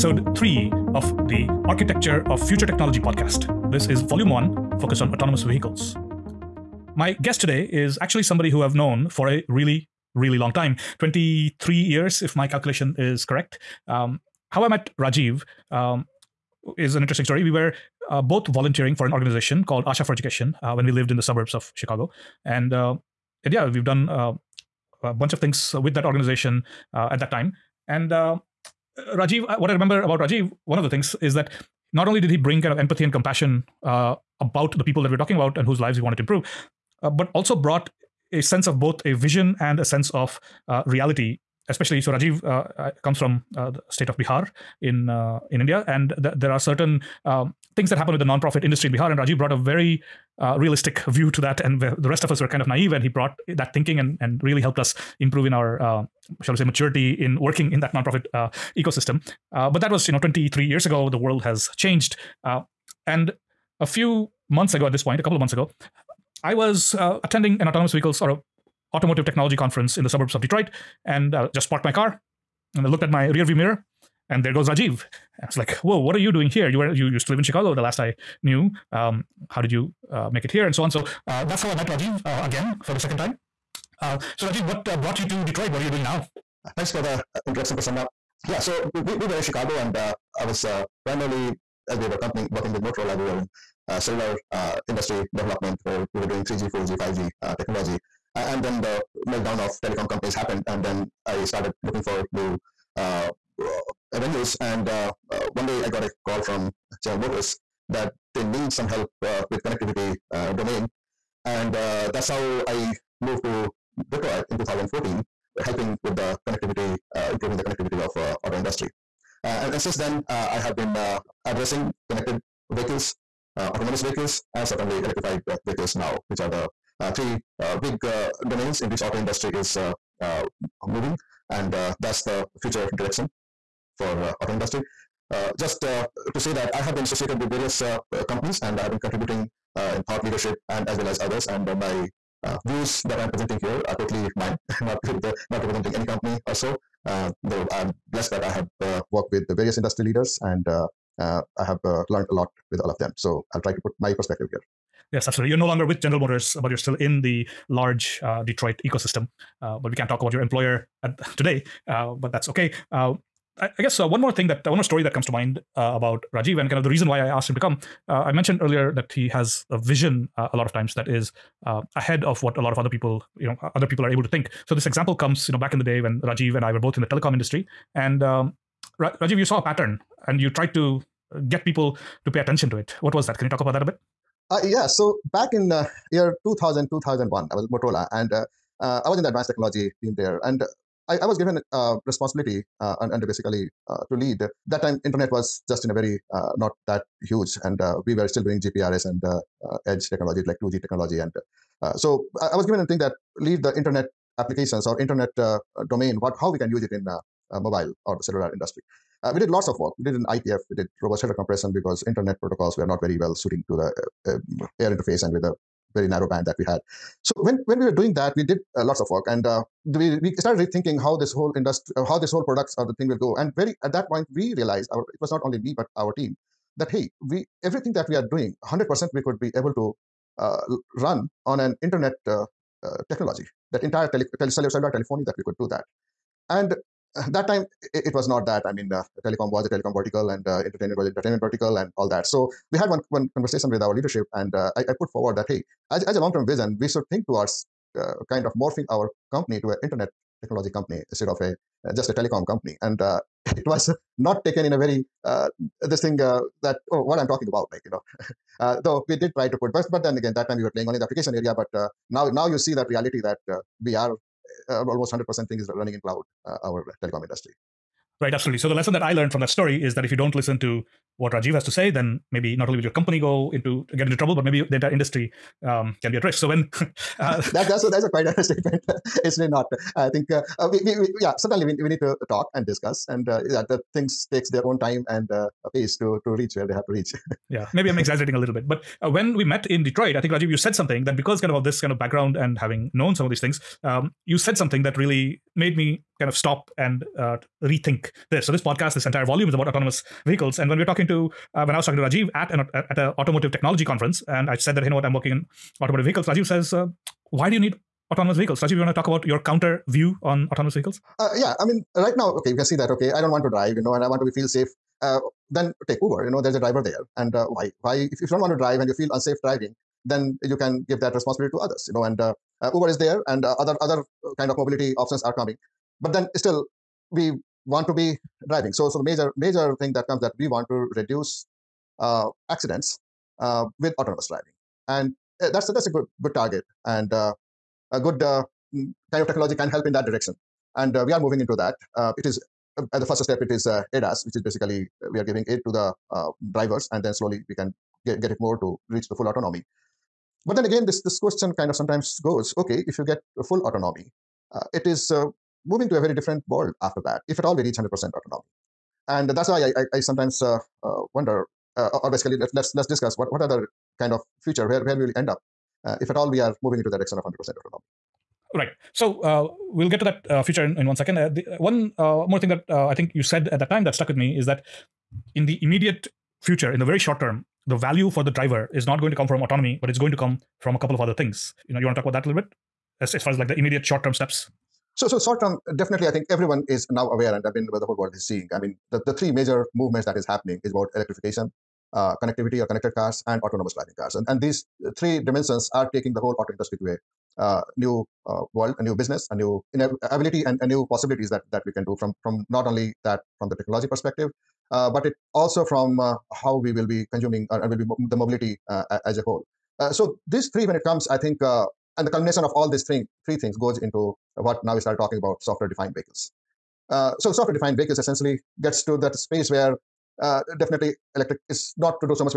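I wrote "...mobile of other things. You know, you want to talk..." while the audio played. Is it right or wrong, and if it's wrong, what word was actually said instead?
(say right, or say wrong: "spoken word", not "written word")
wrong: "couple", not "mobile".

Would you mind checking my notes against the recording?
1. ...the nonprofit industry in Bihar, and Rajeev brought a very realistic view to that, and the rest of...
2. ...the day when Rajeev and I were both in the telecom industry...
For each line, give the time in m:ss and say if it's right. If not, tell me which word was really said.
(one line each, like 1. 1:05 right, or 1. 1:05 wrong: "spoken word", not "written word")
1. 0:48 right
2. 2:55 right.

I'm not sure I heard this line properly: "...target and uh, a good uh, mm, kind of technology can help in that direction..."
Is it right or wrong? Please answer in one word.
right.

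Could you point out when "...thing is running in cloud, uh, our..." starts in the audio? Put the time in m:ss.
4:25.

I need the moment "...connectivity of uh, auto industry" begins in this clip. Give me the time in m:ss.
1:57.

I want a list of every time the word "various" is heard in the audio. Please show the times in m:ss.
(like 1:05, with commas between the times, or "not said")
2:17, 2:29.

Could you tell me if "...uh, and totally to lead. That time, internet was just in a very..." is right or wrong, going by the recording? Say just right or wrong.
wrong.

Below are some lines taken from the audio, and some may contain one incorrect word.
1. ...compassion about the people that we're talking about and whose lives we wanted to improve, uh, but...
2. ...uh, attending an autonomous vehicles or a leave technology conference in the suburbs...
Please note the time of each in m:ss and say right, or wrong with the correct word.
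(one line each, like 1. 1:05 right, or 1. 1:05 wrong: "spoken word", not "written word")
1. 0:33 right
2. 1:06 wrong: "automotive", not "leave".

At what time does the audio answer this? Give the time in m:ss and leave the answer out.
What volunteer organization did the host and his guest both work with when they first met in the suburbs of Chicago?
0:19.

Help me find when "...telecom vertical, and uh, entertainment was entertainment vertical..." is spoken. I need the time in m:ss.
3:59.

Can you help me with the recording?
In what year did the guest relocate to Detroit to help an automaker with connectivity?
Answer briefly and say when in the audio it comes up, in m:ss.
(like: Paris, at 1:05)
2014, at 1:54.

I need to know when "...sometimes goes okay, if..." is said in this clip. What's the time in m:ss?
5:51.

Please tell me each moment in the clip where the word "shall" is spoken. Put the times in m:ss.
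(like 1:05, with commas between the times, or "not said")
0:56.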